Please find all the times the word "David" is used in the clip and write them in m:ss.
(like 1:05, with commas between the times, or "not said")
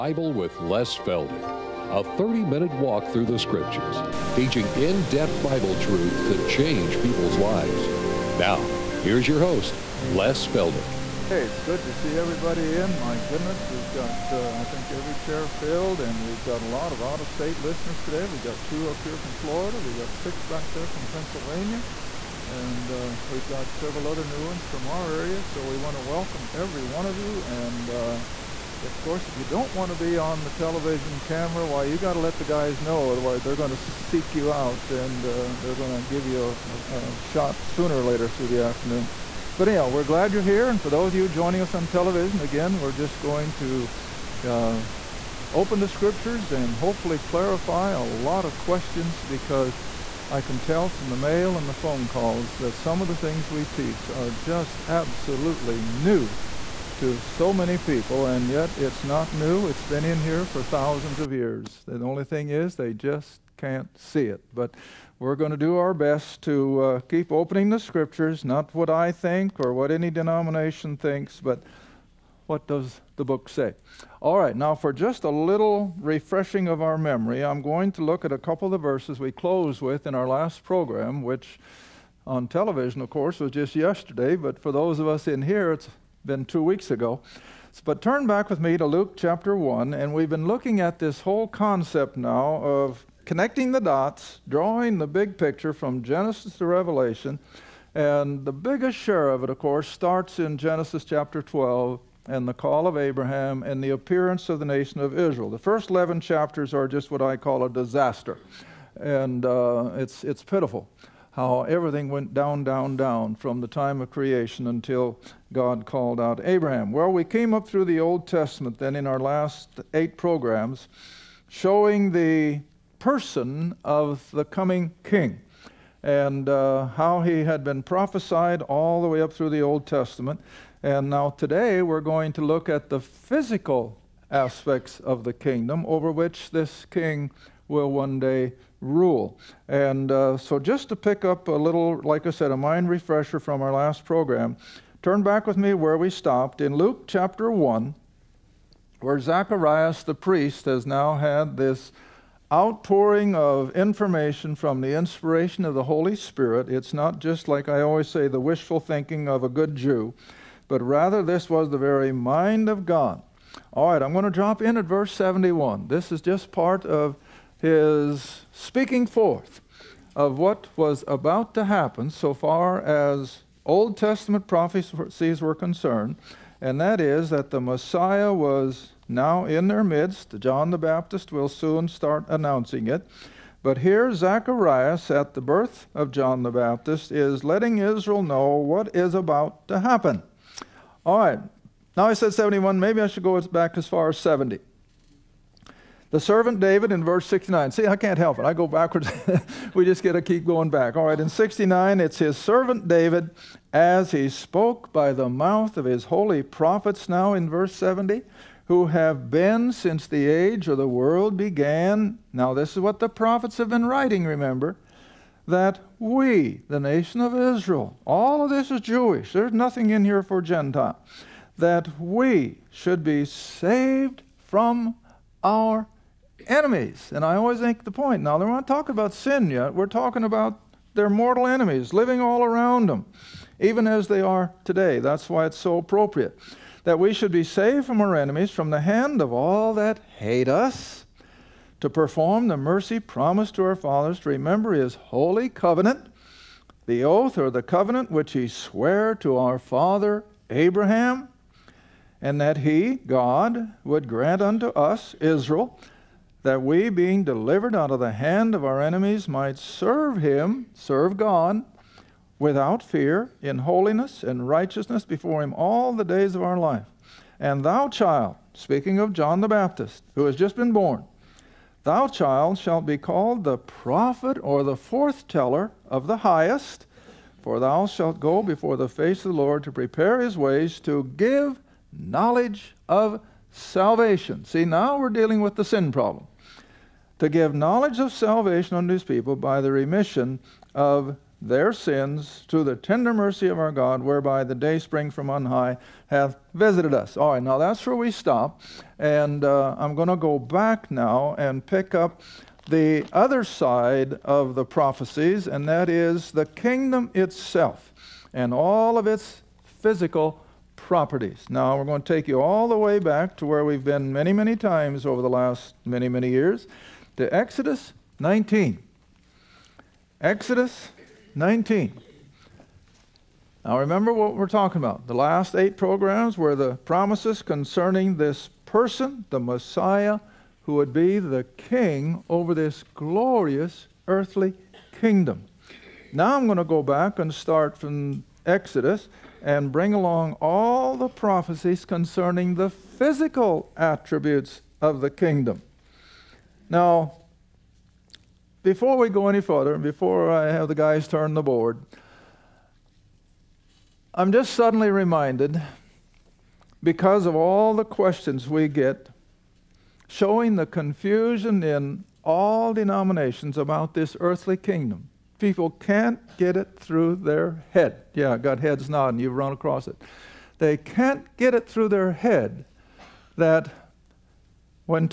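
3:16, 3:22.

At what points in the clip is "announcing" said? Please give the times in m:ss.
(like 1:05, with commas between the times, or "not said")
3:02.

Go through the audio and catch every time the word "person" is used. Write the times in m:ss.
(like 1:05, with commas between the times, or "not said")
2:02, 5:28.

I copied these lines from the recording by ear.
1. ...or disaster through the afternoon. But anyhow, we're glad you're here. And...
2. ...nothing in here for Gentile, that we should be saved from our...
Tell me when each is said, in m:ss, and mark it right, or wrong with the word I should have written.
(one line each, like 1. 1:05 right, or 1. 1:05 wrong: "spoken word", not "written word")
1. 0:37 wrong: "later", not "disaster"
2. 3:39 right.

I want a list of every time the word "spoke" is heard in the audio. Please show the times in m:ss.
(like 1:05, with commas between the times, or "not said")
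3:24.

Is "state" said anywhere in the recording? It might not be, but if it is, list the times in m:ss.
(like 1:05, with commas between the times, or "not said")
0:17.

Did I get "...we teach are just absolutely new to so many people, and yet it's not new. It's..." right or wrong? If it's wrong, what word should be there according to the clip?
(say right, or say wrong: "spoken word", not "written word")
right.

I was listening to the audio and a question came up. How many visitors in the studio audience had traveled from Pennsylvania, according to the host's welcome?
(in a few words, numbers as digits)
6.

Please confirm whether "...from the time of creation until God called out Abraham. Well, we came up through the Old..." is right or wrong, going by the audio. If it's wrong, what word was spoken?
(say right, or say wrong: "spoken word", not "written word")
right.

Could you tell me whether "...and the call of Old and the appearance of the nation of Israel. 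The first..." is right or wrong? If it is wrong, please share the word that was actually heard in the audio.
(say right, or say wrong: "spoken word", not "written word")
wrong: "Abraham", not "Old".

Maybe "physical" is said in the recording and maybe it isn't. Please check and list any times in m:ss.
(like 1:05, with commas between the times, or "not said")
2:12, 5:09, 5:42.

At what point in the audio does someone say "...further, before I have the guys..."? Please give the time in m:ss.
5:49.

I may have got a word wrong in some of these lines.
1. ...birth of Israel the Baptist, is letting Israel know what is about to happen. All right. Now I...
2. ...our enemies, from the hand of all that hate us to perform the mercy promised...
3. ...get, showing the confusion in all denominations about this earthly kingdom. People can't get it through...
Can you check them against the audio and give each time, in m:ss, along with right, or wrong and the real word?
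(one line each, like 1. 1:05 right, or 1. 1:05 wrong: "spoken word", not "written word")
1. 3:05 wrong: "John", not "Israel"
2. 3:58 right
3. 5:58 right.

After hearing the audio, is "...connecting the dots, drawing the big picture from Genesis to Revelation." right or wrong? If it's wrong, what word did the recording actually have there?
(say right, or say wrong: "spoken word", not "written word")
right.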